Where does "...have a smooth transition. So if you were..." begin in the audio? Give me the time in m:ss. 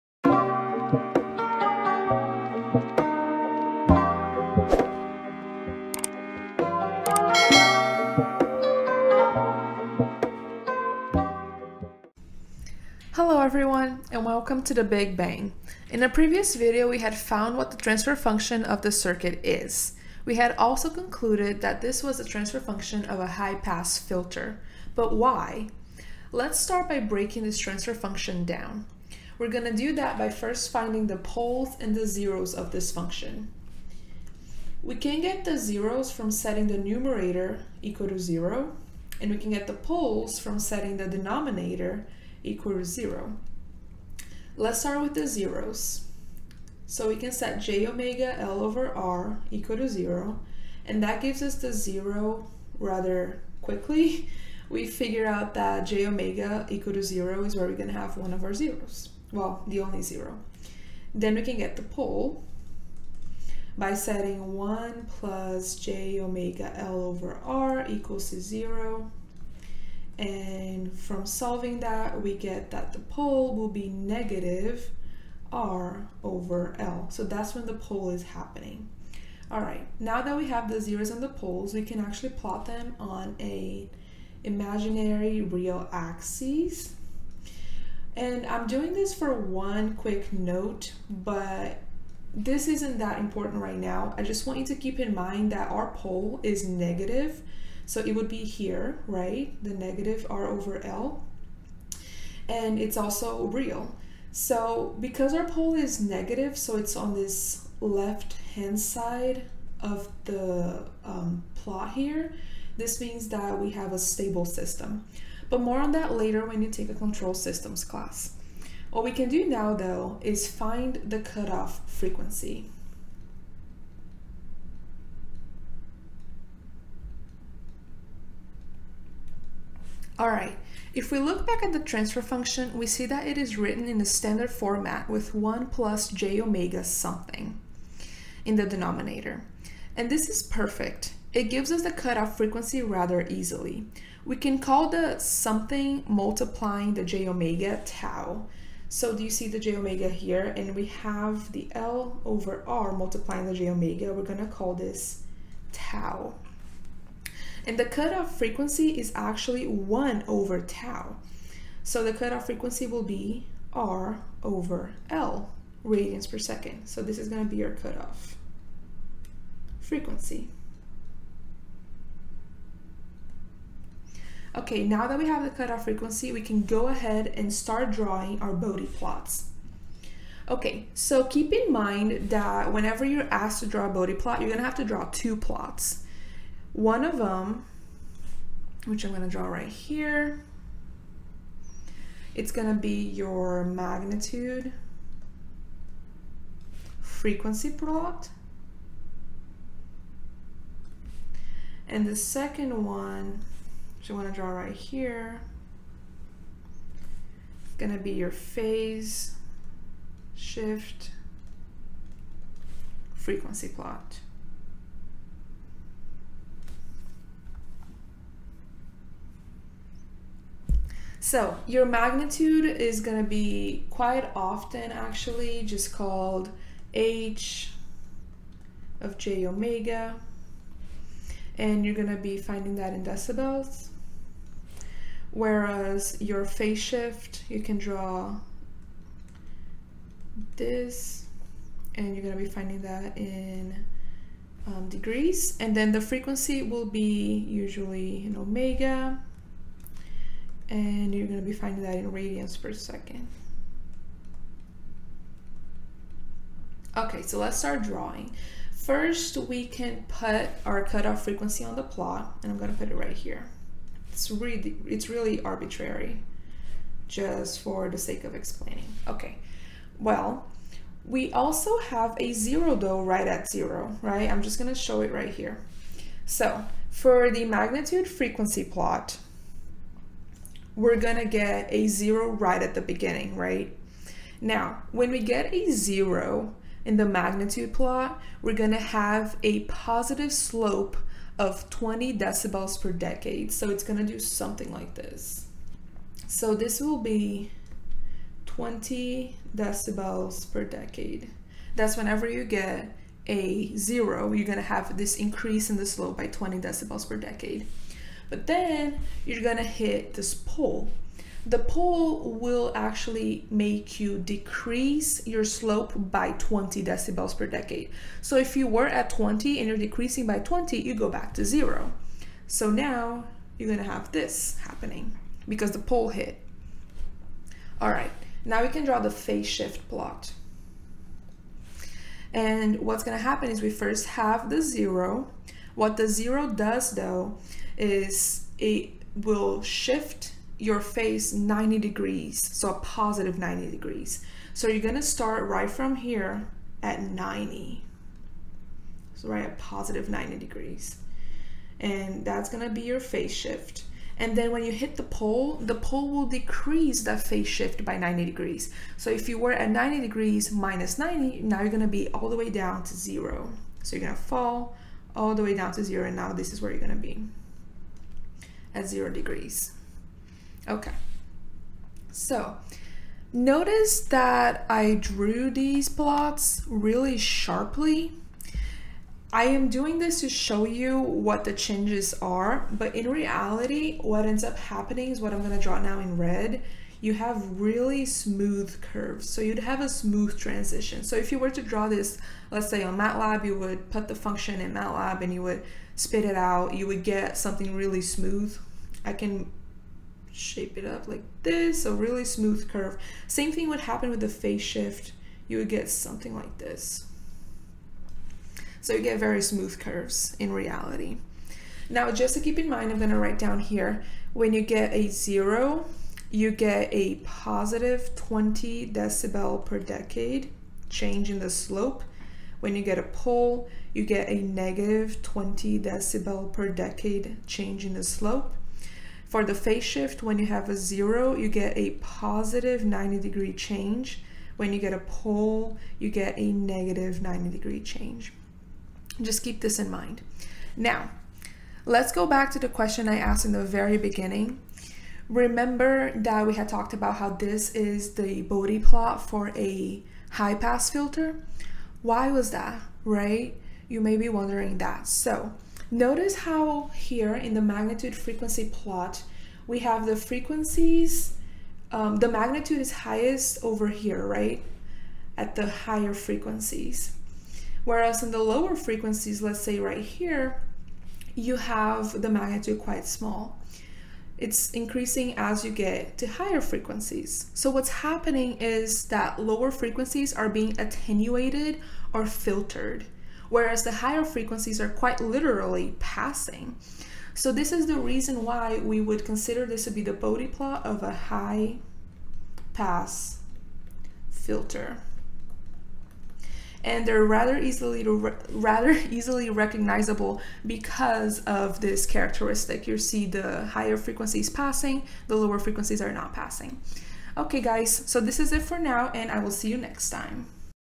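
6:29.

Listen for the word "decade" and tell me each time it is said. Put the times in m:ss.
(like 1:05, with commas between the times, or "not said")
4:52, 5:00, 5:07, 5:17, 6:59, 7:06.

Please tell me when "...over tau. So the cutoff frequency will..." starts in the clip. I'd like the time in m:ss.
2:40.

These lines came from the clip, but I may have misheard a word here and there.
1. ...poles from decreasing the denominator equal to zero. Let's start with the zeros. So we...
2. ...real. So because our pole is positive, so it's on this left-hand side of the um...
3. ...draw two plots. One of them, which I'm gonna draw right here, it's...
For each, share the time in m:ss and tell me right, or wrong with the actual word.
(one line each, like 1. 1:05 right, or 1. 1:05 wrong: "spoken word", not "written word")
1. 0:39 wrong: "setting", not "decreasing"
2. 1:43 wrong: "negative", not "positive"
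3. 3:04 right.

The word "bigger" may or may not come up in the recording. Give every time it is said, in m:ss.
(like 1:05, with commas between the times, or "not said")
not said.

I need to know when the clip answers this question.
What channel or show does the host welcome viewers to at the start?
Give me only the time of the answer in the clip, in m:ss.
0:14.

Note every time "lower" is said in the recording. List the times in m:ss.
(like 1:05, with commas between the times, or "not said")
7:48, 7:59, 8:25.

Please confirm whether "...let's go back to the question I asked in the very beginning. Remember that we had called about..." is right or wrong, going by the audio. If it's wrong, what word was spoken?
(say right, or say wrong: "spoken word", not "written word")
wrong: "talked", not "called".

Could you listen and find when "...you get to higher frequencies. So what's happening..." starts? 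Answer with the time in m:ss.
7:55.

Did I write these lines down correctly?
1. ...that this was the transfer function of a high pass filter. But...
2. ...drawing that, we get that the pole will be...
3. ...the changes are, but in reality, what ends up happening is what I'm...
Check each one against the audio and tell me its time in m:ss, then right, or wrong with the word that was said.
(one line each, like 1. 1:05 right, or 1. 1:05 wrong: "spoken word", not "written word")
1. 0:21 right
2. 1:11 wrong: "solving", not "drawing"
3. 6:21 right.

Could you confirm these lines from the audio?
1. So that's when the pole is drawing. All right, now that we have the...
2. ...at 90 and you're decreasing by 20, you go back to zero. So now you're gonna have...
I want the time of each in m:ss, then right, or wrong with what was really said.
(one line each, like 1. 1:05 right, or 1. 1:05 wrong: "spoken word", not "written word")
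1. 1:17 wrong: "happening", not "drawing"
2. 5:18 wrong: "20", not "90".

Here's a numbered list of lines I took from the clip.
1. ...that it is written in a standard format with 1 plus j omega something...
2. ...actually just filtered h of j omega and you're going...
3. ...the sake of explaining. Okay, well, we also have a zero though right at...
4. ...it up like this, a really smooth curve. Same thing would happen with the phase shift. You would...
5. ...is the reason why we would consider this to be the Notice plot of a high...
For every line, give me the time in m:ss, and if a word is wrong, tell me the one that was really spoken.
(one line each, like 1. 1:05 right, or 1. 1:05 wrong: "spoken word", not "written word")
1. 2:13 right
2. 3:44 wrong: "called", not "filtered"
3. 4:27 right
4. 6:40 right
5. 8:07 wrong: "Bode", not "Notice".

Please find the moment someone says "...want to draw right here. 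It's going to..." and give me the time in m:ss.
3:24.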